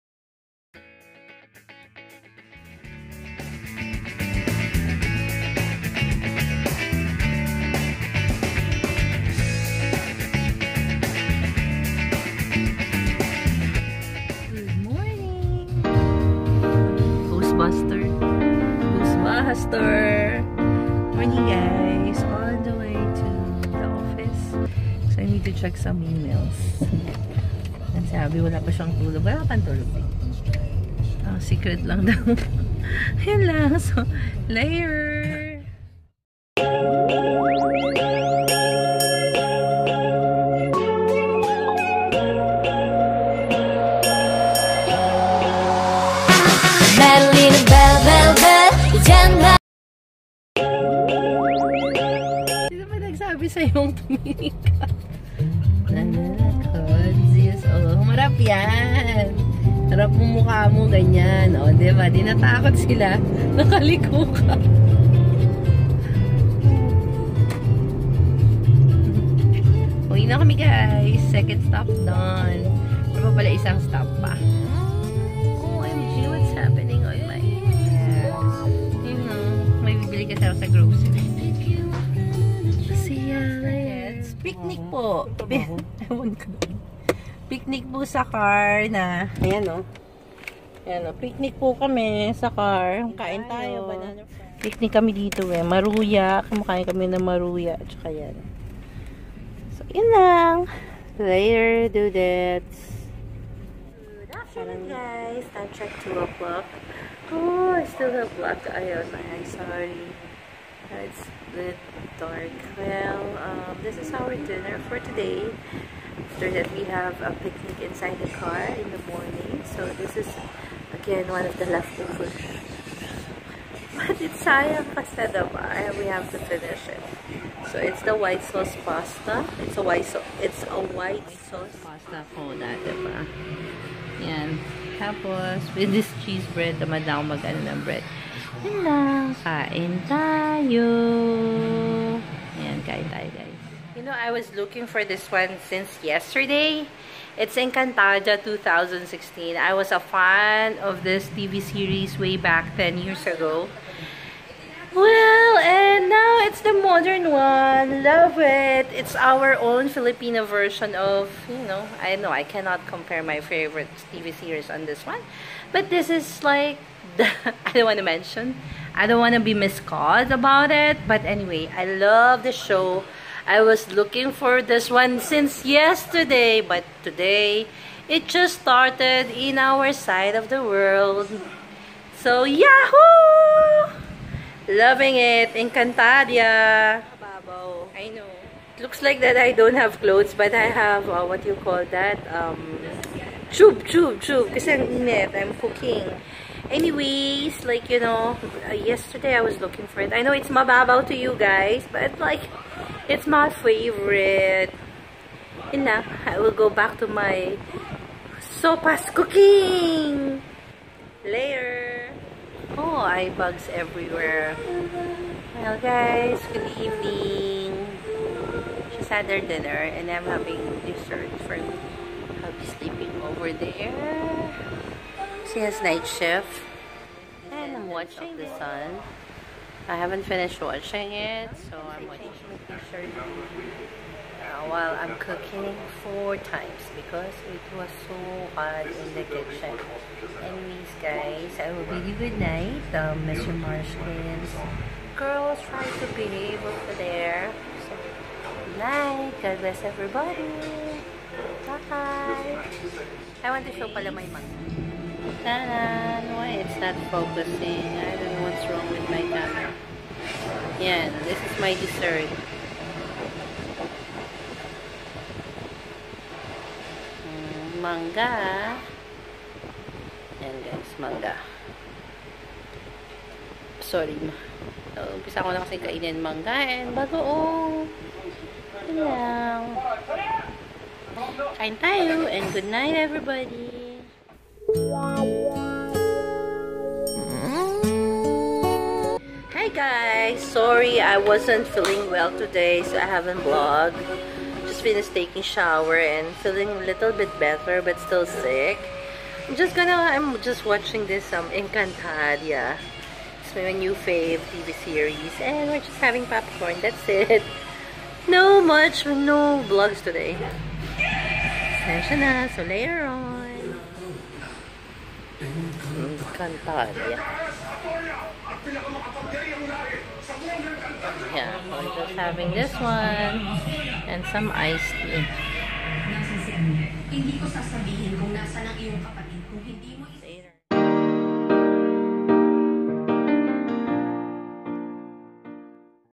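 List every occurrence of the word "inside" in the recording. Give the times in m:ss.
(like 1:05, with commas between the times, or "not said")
1:57.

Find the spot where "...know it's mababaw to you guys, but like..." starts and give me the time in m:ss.
3:20.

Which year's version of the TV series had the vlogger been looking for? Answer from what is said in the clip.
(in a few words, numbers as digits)
2016.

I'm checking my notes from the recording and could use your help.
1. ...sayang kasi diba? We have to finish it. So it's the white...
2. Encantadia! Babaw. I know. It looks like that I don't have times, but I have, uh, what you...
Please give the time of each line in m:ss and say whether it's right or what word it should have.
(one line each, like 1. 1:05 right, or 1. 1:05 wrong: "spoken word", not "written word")
1. 2:04 right
2. 3:05 wrong: "clothes", not "times".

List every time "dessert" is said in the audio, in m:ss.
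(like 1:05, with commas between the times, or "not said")
3:40, 4:21.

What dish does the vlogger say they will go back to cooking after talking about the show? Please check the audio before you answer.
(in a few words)
Sopas.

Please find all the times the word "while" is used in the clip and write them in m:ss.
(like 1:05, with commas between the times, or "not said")
3:54.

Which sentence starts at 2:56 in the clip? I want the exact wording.
But today, it just started in our side of the world.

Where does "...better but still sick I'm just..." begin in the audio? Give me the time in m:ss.
4:57.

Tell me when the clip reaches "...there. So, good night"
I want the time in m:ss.
4:06.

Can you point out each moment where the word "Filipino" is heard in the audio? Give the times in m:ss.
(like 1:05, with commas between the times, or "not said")
2:39.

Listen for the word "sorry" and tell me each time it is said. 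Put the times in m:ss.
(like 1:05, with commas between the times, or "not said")
1:49, 4:33, 4:50.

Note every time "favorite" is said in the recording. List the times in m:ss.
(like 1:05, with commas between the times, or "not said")
2:43, 3:23.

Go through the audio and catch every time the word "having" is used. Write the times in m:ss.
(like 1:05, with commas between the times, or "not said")
3:40, 5:06, 5:22.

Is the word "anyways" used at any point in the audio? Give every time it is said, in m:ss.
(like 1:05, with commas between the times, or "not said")
2:51, 3:16, 4:00.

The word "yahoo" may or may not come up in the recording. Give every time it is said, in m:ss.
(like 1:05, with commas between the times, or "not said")
3:02.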